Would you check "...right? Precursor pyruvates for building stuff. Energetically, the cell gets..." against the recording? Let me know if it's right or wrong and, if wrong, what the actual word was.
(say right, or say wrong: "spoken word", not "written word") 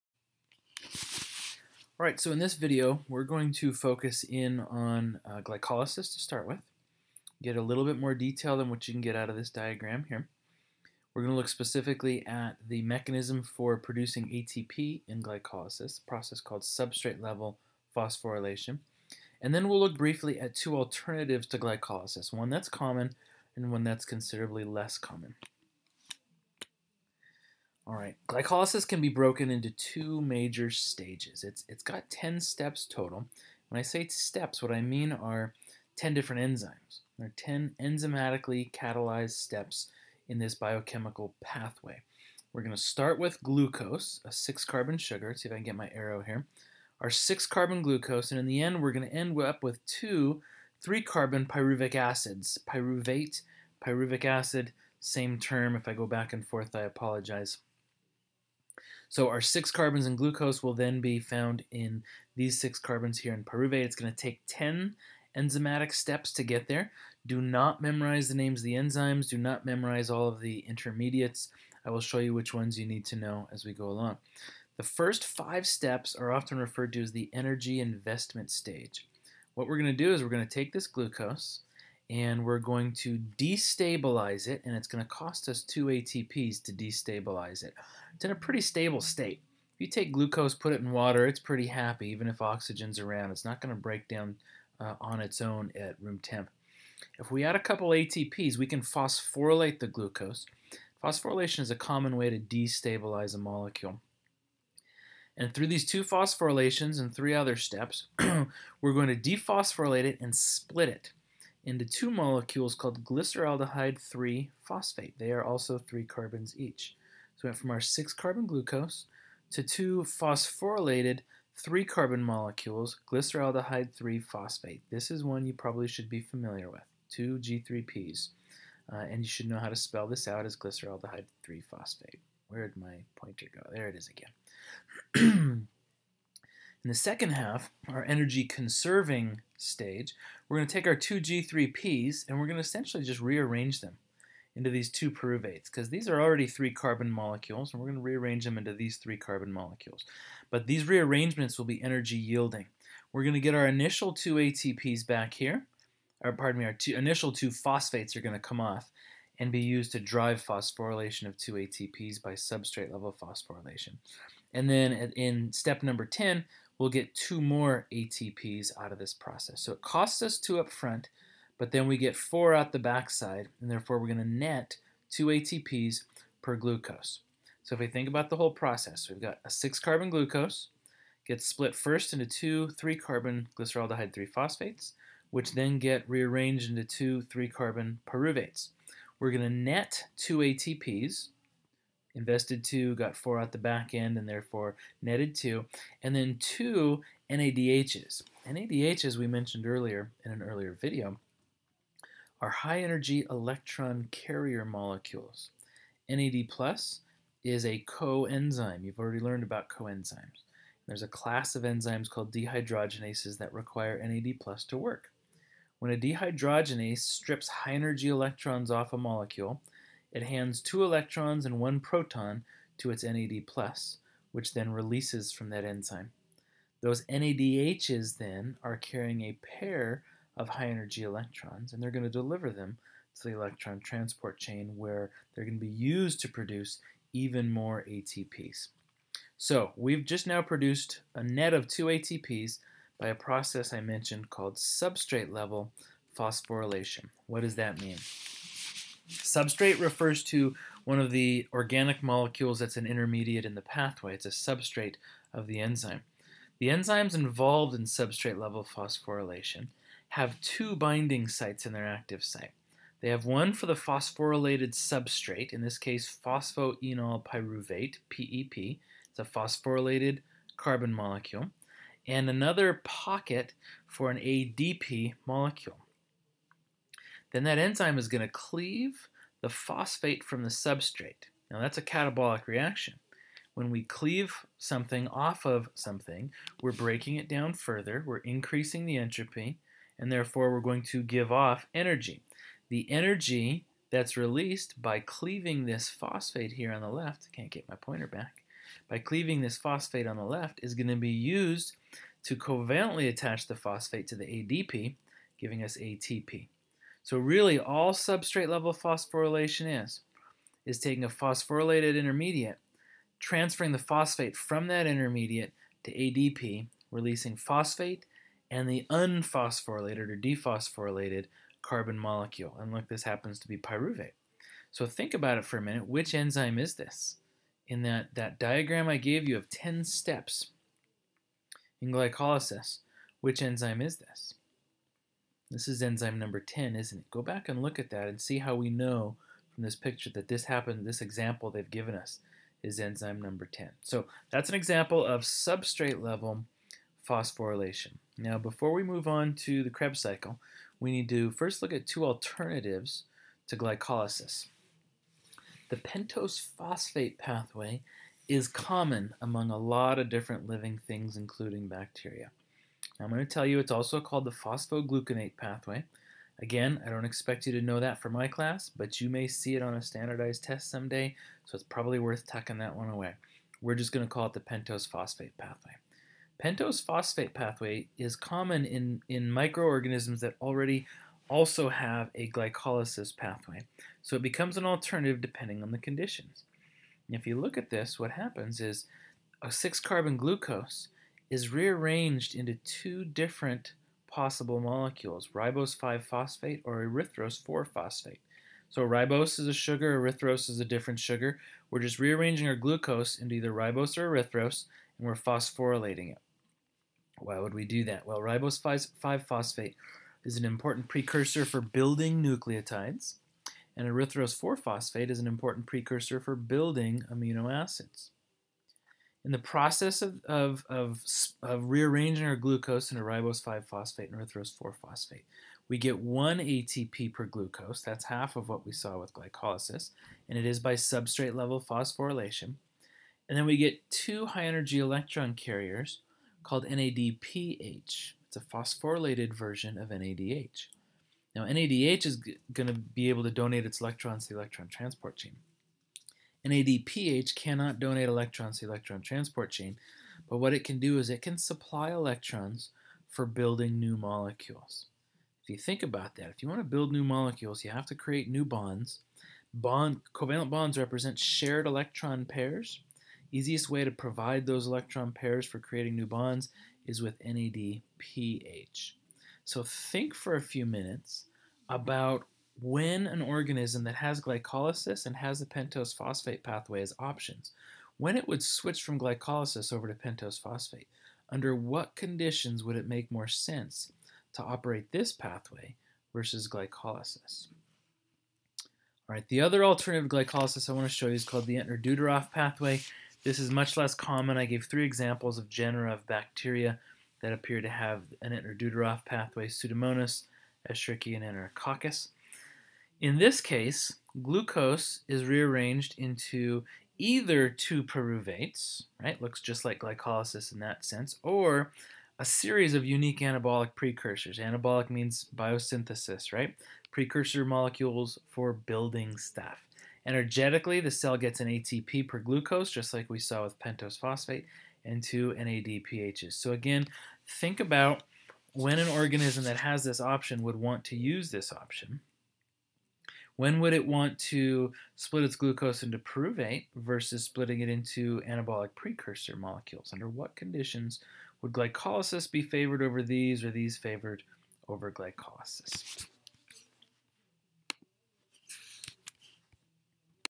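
wrong: "molecules", not "pyruvates".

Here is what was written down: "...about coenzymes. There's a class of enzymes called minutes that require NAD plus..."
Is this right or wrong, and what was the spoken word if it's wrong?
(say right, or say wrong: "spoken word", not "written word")
wrong: "dehydrogenases", not "minutes".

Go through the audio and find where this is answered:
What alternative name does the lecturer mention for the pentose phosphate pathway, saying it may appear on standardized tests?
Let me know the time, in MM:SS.
06:04.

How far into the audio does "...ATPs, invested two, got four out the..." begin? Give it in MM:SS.
03:10.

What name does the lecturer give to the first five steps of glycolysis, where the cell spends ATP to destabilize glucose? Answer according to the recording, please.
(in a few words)
energy investment stage.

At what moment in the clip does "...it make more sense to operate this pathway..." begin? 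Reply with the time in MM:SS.
08:02.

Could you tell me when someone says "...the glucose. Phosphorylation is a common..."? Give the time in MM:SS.
01:39.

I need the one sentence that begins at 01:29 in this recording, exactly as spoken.
If you take glucose, put it in water, it's pretty happy, even if oxygen's around.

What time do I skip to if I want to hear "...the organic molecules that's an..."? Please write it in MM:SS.
04:11.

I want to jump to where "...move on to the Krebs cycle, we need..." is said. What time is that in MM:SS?
05:48.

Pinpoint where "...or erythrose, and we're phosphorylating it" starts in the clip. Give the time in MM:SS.
06:43.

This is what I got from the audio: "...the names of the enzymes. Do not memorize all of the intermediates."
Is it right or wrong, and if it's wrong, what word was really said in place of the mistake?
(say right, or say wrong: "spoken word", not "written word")
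right.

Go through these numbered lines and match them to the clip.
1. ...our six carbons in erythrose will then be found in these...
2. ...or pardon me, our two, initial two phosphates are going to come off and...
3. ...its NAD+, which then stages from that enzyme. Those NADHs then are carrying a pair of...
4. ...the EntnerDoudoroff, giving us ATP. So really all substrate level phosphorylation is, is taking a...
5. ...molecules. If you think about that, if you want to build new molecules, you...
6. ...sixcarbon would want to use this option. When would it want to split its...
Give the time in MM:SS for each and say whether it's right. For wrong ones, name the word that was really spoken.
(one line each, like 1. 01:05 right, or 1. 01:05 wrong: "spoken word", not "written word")
1. 00:59 wrong: "glucose", not "erythrose"
2. 02:36 right
3. 03:42 wrong: "releases", not "stages"
4. 05:04 wrong: "ADP", not "EntnerDoudoroff"
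5. 07:33 right
6. 08:50 wrong: "option", not "sixcarbon".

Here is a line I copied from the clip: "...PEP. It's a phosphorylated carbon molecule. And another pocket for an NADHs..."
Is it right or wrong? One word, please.
wrong.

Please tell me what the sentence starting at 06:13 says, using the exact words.
We're just going to call it the pentose phosphate pathway.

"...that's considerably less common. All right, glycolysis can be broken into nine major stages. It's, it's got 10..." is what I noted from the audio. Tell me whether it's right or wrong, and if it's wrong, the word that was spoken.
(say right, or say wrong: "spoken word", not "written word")
wrong: "two", not "nine".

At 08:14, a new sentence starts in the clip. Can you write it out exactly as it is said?
I gave three examples of genera of bacteria that appear to have an Entner-Doudoroff pathway, Pseudomonas, Escherichia, and Enterococcus.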